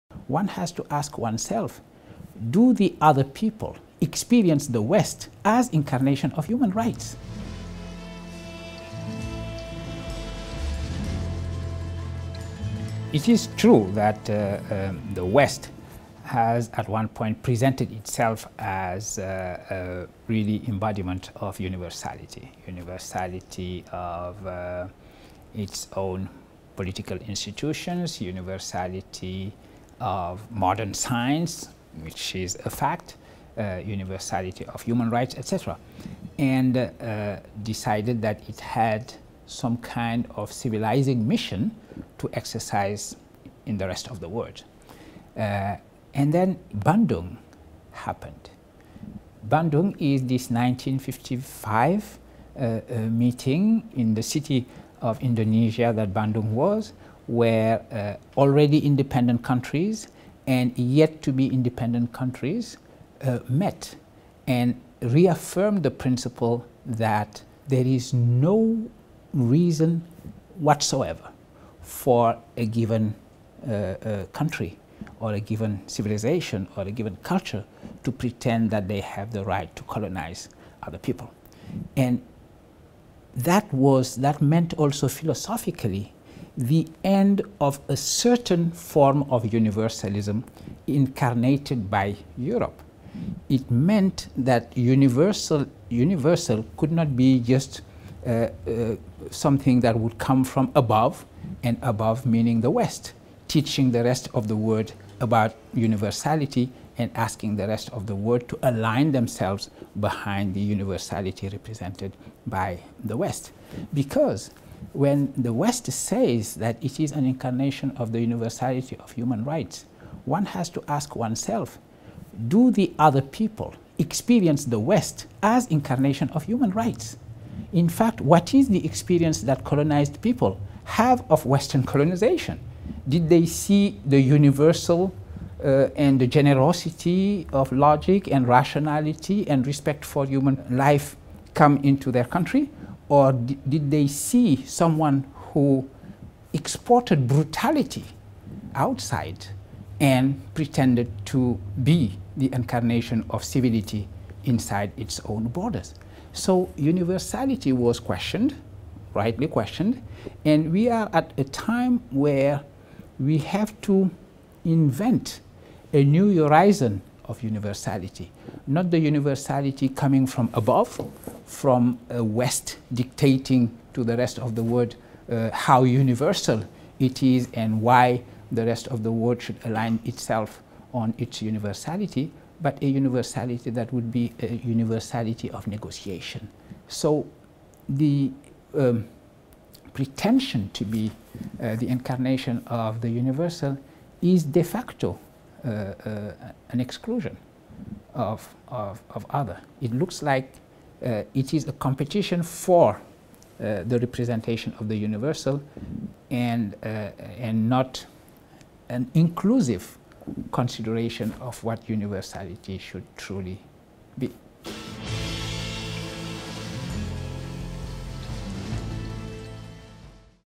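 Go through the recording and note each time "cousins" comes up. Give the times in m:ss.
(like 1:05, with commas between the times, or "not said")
not said.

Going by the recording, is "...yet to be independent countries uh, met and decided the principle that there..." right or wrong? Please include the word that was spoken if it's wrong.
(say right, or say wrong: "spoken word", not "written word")
wrong: "reaffirmed", not "decided".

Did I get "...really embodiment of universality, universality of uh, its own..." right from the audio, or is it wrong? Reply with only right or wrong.
right.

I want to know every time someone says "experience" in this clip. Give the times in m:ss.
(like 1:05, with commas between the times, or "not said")
0:03, 2:03, 2:08.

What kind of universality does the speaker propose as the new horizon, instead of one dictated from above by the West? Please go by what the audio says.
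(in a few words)
universality of negotiation.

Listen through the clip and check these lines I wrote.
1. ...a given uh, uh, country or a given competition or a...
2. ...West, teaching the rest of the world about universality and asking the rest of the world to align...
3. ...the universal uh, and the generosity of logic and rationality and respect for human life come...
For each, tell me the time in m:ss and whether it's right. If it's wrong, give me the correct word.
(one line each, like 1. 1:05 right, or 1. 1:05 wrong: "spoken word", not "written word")
1. 1:12 wrong: "civilization", not "competition"
2. 1:42 right
3. 2:14 right.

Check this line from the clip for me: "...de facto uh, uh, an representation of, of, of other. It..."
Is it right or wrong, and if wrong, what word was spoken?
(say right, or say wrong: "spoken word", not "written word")
wrong: "exclusion", not "representation".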